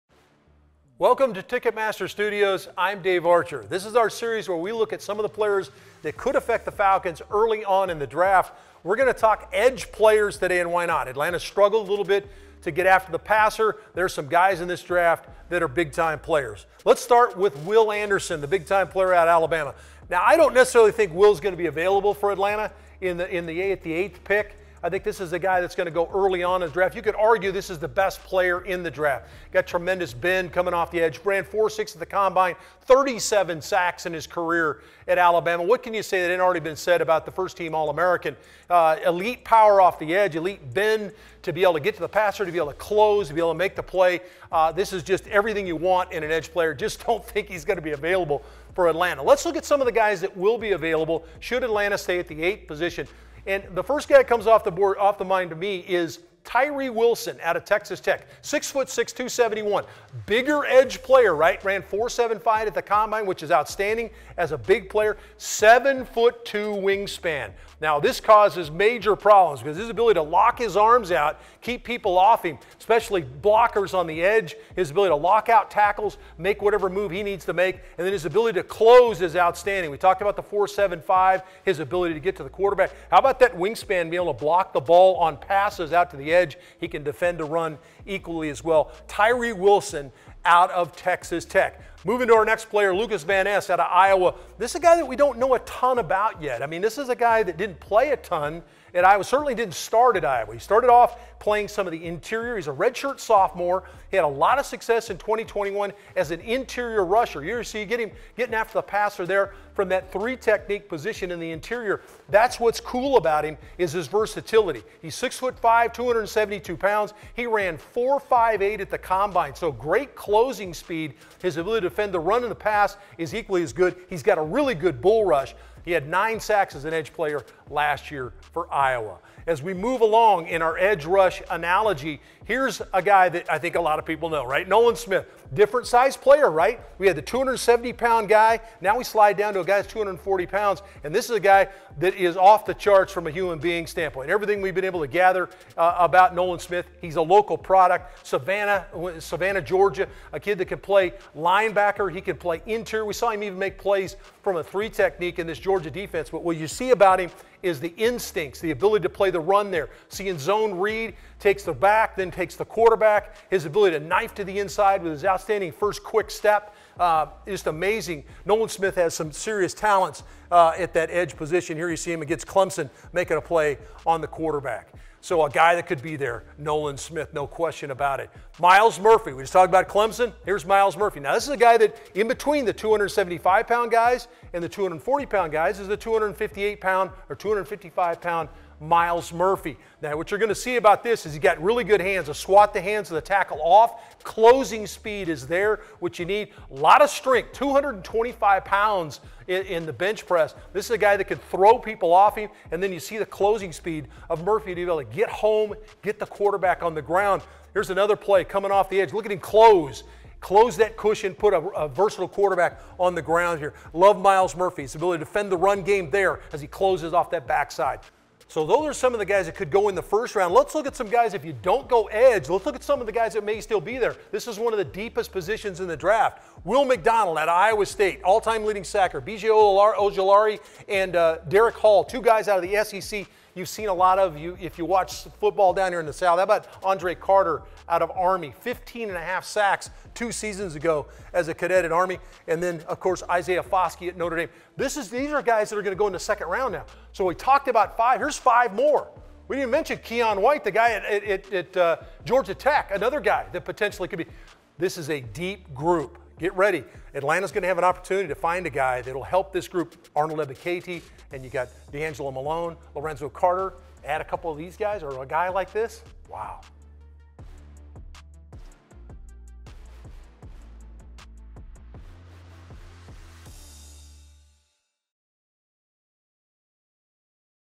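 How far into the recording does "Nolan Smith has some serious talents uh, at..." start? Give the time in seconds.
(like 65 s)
168 s.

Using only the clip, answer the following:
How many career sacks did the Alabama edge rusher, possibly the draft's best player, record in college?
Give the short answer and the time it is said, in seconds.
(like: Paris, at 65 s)
37, at 32 s.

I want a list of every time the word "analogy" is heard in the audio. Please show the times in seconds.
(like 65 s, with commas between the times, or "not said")
131 s.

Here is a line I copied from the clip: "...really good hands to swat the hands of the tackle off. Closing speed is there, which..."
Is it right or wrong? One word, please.
right.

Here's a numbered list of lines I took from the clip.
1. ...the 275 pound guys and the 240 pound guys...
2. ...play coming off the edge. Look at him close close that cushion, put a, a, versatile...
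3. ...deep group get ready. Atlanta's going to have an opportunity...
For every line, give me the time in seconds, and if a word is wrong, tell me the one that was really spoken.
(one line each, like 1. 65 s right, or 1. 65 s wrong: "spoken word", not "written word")
1. 182 s right
2. 208 s right
3. 255 s right.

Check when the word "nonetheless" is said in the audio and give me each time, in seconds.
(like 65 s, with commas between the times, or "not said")
not said.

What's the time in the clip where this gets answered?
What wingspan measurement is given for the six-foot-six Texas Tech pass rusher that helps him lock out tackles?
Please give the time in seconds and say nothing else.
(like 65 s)
65 s.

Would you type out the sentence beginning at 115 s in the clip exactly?
He's six foot five, 272 pounds.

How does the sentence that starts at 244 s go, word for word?
This is, these are guys that are going to go in the second round now.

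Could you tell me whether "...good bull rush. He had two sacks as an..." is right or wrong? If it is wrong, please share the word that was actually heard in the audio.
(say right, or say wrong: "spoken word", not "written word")
wrong: "nine", not "two".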